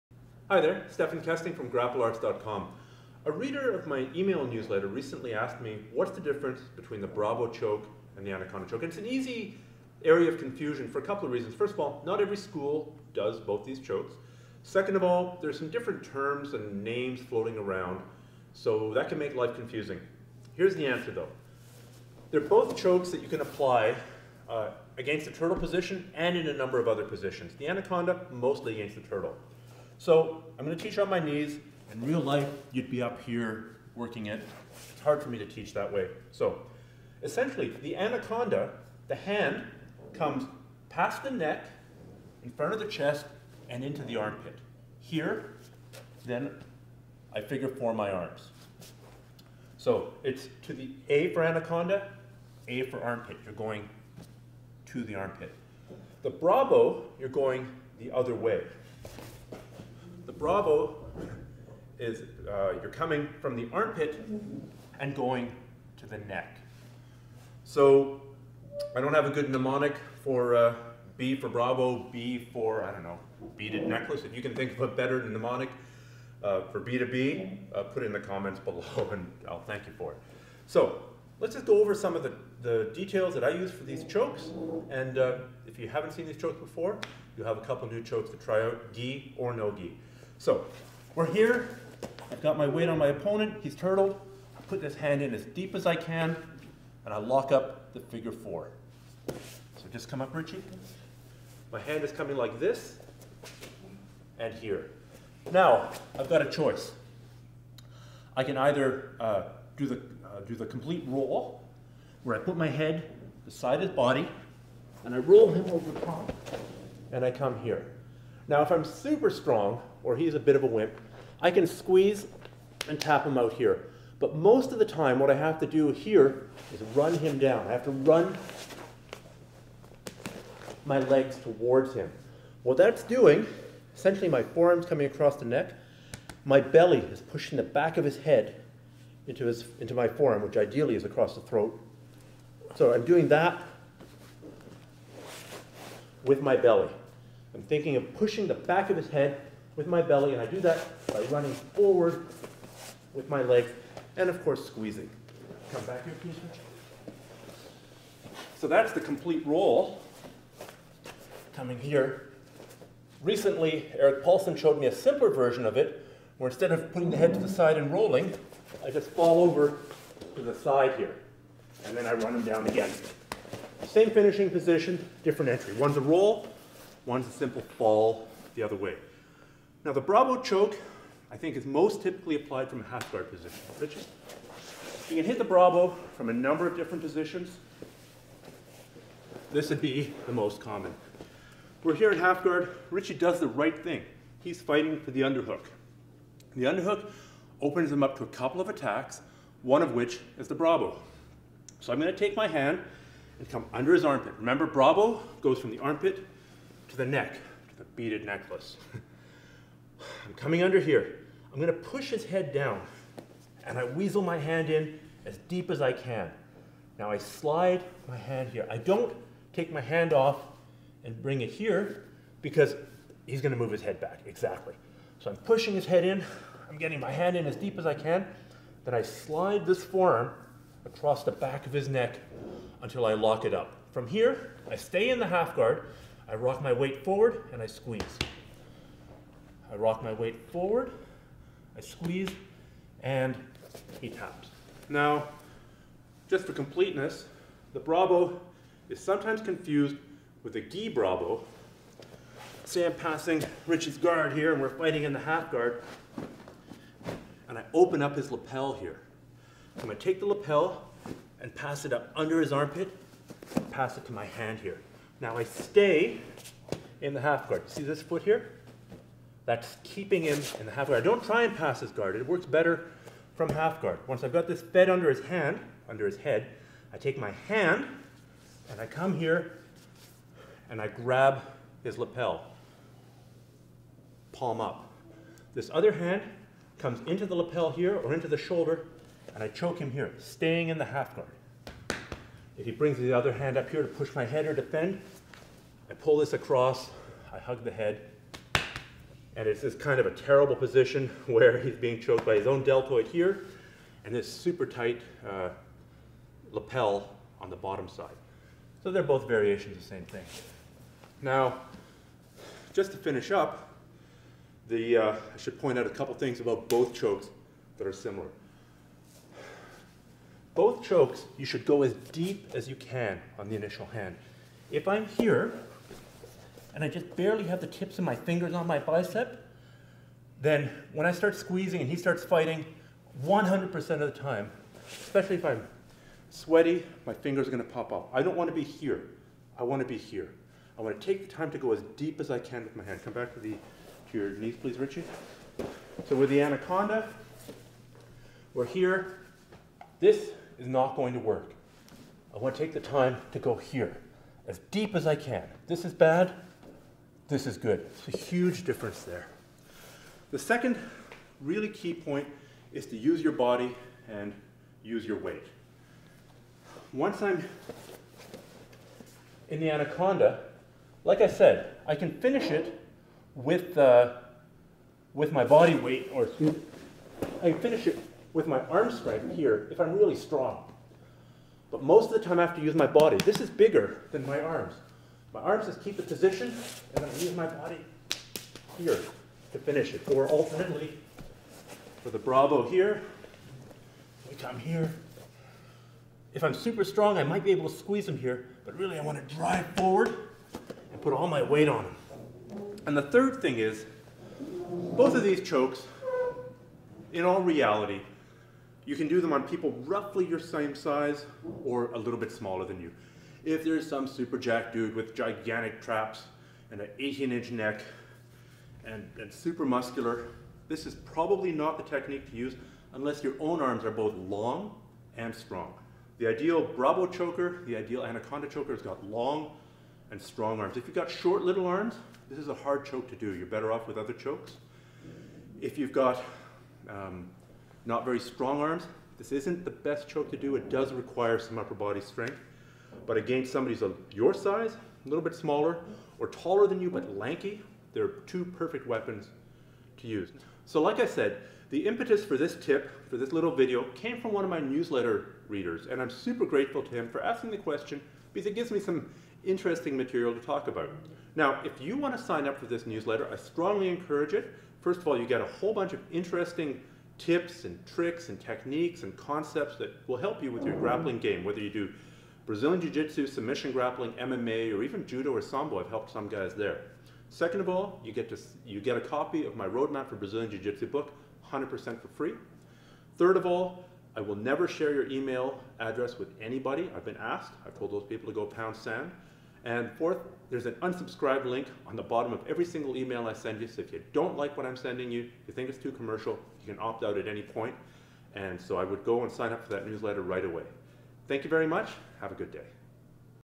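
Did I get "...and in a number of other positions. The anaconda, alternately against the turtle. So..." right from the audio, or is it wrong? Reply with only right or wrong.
wrong.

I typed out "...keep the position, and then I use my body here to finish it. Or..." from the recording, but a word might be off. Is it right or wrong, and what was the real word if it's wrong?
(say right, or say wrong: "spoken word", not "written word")
right.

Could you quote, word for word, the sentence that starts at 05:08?
So they're both variations of the same thing.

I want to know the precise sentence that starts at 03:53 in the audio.
From here, I stay in the half guard, I rock my weight forward and I squeeze.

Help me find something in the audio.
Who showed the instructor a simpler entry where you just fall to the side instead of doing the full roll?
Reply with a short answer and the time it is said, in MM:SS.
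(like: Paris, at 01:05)
Erik Paulson, at 02:43.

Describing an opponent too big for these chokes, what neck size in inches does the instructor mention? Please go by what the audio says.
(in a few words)
18 inches.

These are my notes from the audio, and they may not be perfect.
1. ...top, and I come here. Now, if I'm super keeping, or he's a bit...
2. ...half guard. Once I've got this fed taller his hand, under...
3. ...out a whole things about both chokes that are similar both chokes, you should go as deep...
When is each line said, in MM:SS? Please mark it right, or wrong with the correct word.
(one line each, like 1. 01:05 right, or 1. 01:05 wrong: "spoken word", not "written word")
1. 01:56 wrong: "strong", not "keeping"
2. 04:33 wrong: "under", not "taller"
3. 05:15 wrong: "couple", not "whole".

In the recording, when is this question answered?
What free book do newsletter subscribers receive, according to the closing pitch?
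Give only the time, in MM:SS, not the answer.
07:59.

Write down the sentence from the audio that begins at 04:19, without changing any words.
I'm gonna take the lapel and pass it up under his armpit, pass it to my hand here.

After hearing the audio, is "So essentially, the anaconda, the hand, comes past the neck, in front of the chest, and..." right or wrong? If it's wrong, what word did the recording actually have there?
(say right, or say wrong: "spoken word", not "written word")
right.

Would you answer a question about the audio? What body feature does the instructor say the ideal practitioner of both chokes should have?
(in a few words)
Long and strong arms.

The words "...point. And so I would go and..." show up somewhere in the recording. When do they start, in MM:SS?
08:17.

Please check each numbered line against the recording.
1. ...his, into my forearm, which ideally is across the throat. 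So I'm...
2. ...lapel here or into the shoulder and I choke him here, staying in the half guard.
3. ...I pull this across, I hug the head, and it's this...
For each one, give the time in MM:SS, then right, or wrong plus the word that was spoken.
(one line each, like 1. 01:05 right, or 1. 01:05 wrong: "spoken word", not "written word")
1. 02:19 right
2. 04:47 right
3. 04:55 right.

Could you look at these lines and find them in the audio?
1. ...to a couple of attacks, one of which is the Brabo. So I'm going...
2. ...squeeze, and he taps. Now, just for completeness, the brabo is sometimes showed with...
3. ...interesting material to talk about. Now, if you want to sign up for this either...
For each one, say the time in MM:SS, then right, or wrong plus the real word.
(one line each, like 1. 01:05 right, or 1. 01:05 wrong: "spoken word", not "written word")
1. 03:18 right
2. 04:01 wrong: "confused", not "showed"
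3. 07:39 wrong: "newsletter", not "either".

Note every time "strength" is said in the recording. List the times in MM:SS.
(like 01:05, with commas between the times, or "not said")
06:18, 07:22.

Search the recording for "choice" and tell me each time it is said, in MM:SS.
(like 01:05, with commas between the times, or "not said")
01:46.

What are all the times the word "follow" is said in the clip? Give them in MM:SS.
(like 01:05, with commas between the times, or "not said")
not said.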